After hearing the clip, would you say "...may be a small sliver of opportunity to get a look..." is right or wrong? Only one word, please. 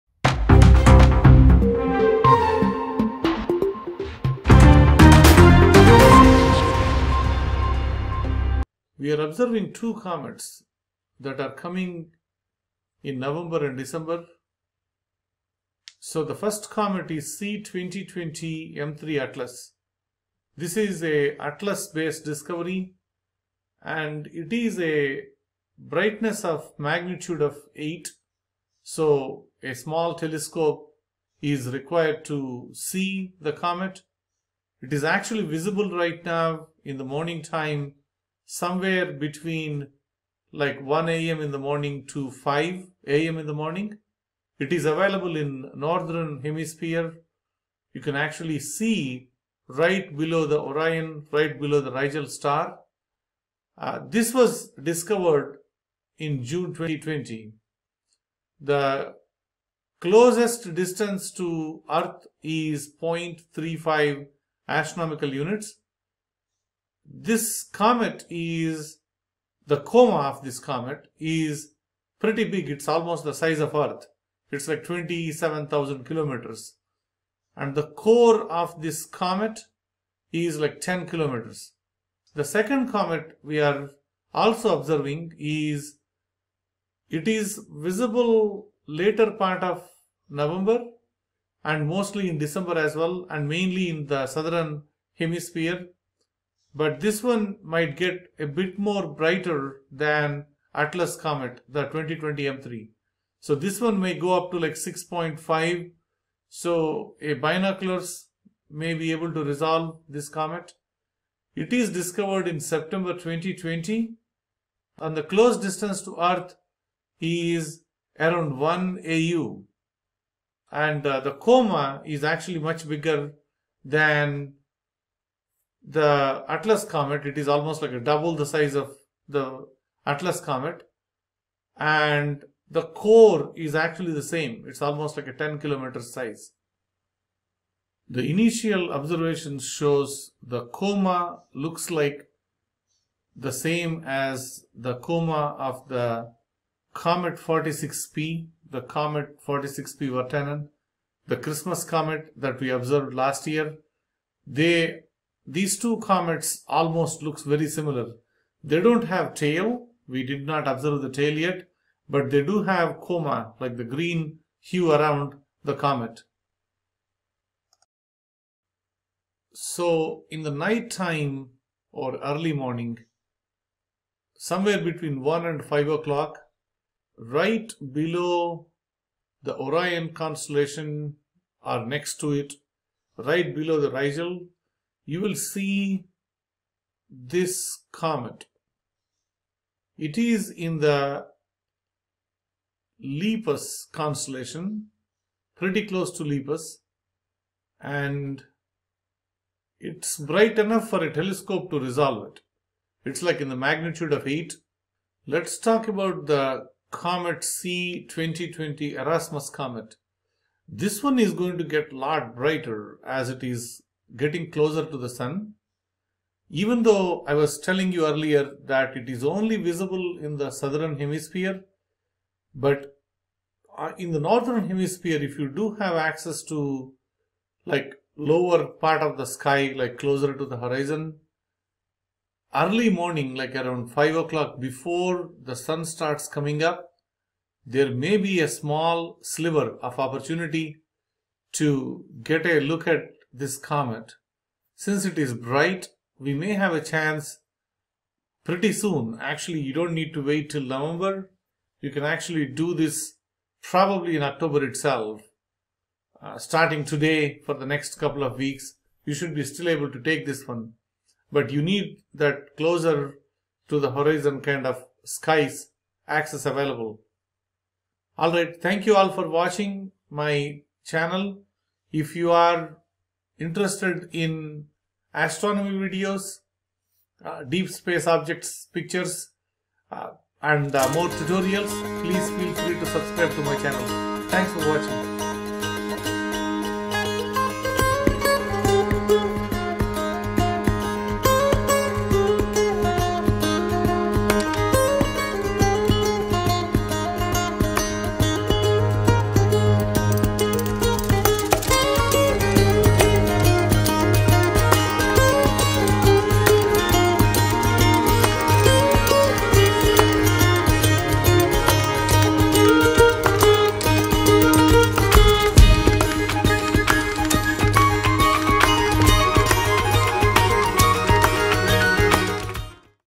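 right.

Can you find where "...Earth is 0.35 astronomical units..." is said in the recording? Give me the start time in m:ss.
1:01.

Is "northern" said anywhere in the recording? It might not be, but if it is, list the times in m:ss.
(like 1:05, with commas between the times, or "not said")
0:45, 3:44.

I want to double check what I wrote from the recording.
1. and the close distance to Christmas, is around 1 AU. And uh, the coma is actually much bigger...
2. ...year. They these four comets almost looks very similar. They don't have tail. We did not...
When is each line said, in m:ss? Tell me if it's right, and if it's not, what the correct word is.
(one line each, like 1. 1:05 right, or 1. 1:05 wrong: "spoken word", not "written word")
1. 1:54 wrong: "Earth", not "Christmas"
2. 2:33 wrong: "two", not "four".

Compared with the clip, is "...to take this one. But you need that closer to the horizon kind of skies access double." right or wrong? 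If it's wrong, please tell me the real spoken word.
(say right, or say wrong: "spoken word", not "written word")
wrong: "available", not "double".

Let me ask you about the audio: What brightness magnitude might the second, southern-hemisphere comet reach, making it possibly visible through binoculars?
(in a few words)
6.5.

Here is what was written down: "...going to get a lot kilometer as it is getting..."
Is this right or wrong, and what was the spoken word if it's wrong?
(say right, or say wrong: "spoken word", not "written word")
wrong: "brighter", not "kilometer".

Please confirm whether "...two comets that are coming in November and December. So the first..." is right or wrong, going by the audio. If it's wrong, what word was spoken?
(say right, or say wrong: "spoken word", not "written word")
right.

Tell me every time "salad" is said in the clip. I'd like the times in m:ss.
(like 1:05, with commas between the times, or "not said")
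not said.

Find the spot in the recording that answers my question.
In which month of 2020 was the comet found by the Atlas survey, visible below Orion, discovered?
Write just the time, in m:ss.
0:56.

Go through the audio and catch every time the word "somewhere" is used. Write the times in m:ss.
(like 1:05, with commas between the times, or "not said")
0:38, 2:54.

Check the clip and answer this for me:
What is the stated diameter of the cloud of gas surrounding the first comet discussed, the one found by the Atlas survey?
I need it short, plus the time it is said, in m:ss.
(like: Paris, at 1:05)
27,000 kilometers, at 1:14.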